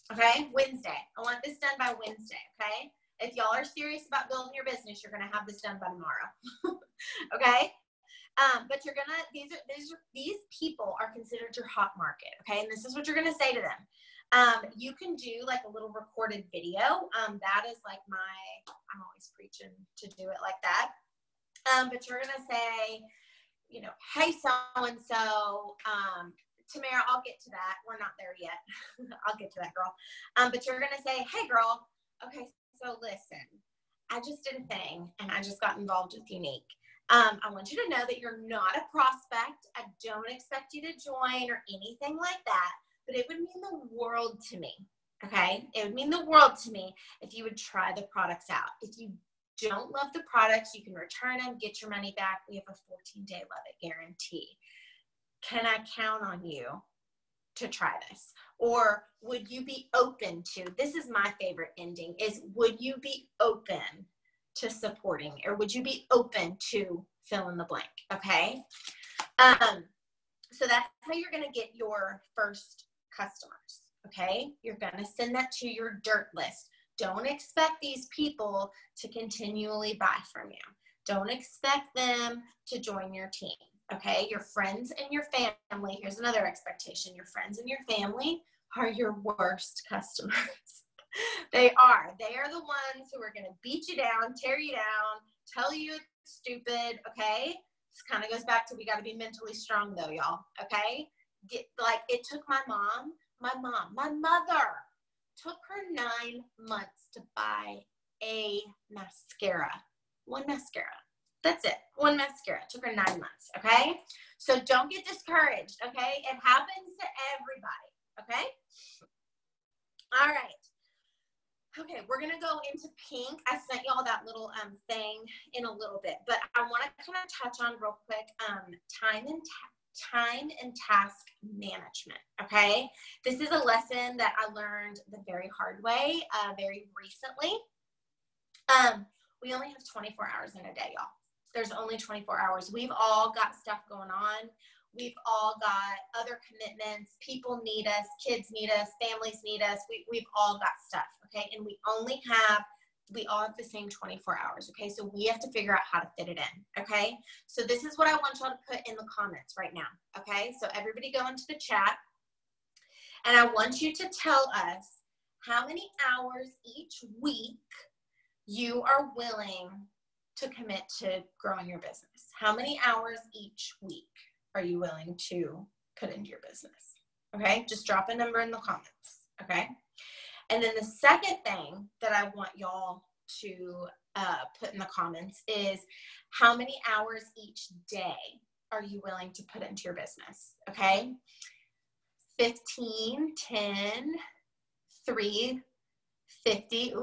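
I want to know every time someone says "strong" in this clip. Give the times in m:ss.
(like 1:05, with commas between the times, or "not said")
1:39.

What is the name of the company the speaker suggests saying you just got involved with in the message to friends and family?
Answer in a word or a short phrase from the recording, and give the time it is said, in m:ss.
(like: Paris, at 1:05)
Younique, at 0:36.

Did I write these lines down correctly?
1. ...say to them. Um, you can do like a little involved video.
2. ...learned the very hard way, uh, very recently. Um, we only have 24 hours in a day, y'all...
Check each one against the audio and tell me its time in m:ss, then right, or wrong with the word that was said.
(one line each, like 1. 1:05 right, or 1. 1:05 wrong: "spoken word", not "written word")
1. 0:13 wrong: "recorded", not "involved"
2. 2:14 right.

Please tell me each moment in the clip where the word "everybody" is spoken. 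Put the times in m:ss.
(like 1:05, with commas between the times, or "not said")
1:57, 2:40.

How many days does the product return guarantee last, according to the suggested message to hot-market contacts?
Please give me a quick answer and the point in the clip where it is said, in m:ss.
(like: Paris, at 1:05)
14, at 0:52.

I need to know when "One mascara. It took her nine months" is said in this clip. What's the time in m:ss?
1:51.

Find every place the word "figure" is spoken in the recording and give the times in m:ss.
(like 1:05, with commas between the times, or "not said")
2:35.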